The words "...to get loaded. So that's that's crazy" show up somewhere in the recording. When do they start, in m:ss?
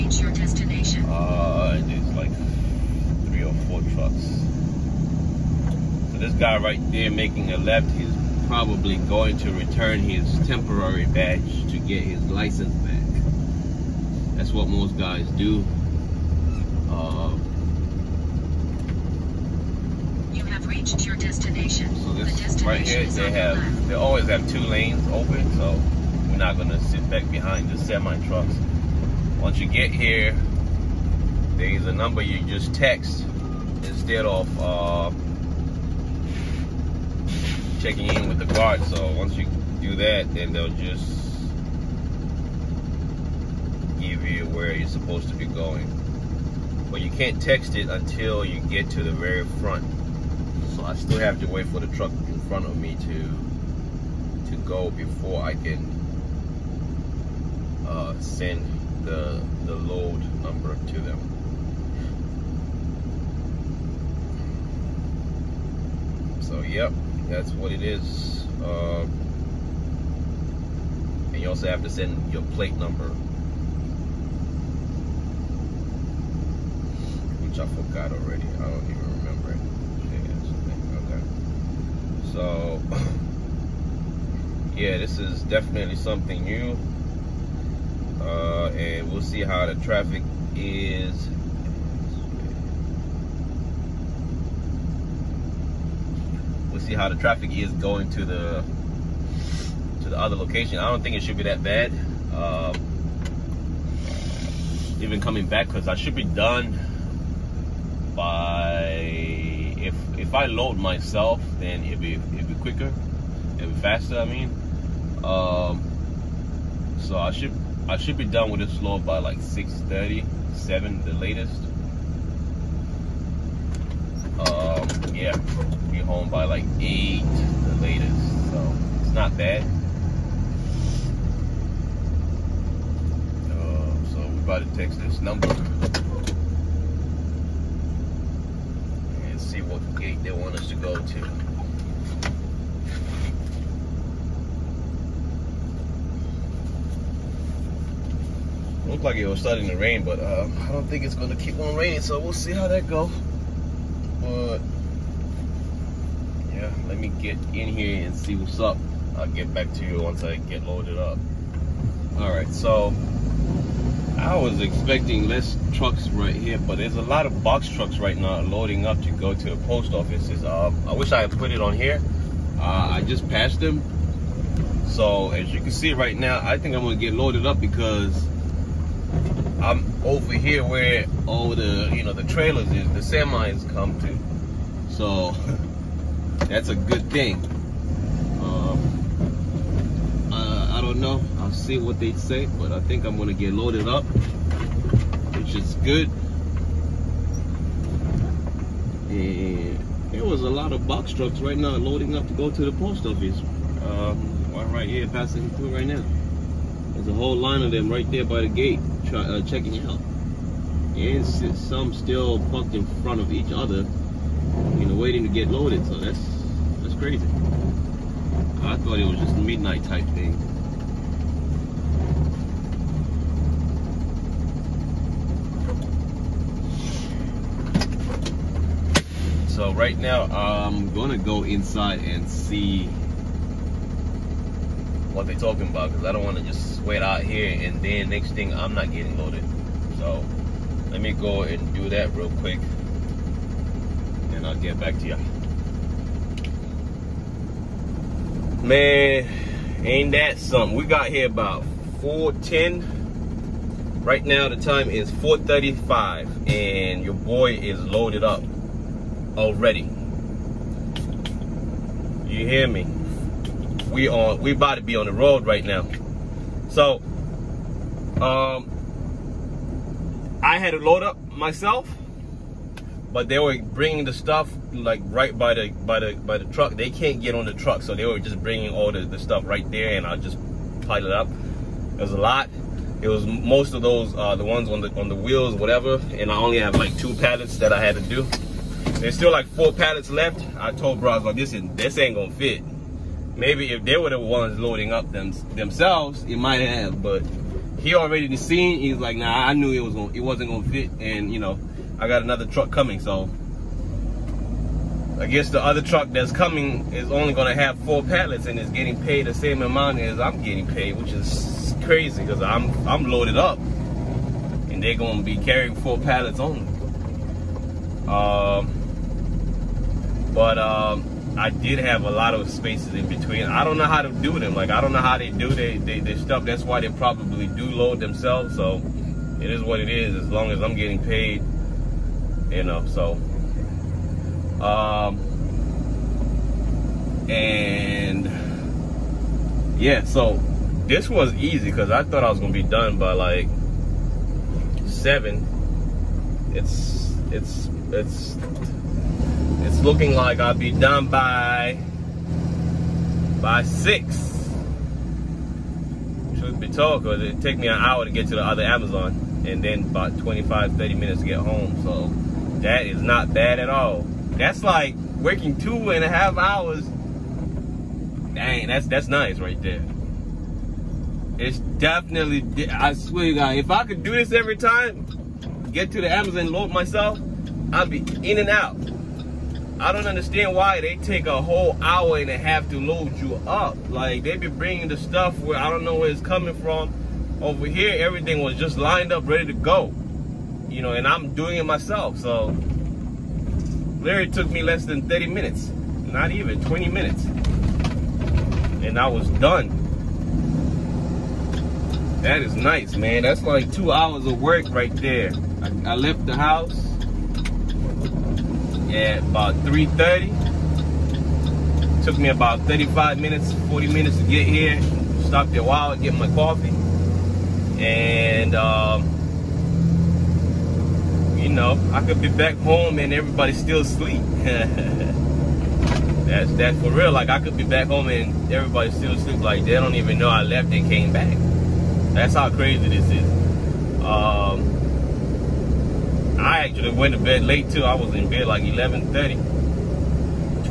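3:35.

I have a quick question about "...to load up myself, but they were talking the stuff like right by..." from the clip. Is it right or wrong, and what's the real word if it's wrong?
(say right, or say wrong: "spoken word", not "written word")
wrong: "bringing", not "talking".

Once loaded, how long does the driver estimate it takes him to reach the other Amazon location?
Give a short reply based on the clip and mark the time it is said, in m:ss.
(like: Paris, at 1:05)
An hour, at 5:57.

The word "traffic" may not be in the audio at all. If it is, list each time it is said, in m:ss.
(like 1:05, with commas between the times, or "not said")
1:29, 1:37.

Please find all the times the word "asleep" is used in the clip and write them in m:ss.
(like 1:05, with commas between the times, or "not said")
7:03, 7:09.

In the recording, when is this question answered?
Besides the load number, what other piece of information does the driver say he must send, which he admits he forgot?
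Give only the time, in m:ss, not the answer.
1:12.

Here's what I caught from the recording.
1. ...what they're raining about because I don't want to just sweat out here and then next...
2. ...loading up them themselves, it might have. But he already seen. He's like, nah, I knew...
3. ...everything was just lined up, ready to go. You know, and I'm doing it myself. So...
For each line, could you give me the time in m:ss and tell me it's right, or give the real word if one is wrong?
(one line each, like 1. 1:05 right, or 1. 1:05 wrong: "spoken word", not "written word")
1. 3:55 wrong: "talking", not "raining"
2. 4:54 right
3. 6:27 right.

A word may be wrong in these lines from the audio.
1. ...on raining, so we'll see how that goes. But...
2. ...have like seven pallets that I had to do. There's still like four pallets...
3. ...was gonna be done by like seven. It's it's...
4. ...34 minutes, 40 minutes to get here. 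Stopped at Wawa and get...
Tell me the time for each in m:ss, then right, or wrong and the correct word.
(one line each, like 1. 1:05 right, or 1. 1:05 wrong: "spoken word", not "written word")
1. 2:31 right
2. 4:46 wrong: "two", not "seven"
3. 5:42 right
4. 6:52 wrong: "35", not "34".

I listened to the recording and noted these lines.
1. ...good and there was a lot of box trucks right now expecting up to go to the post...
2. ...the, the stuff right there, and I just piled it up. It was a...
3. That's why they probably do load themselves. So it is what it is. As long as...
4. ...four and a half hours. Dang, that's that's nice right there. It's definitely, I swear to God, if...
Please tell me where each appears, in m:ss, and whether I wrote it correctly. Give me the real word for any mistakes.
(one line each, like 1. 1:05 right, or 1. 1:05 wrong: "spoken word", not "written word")
1. 3:15 wrong: "loading", not "expecting"
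2. 4:38 right
3. 5:26 right
4. 6:05 wrong: "two", not "four".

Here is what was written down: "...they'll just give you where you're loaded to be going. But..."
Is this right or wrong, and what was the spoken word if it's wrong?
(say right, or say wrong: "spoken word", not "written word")
wrong: "supposed", not "loaded".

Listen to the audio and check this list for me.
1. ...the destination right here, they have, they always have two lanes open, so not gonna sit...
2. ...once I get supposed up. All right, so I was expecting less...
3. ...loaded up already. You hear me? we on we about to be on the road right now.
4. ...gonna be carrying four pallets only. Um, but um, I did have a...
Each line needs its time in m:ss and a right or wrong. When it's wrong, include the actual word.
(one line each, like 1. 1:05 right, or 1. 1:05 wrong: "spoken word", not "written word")
1. 0:22 right
2. 2:40 wrong: "loaded", not "supposed"
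3. 4:17 right
4. 5:14 right.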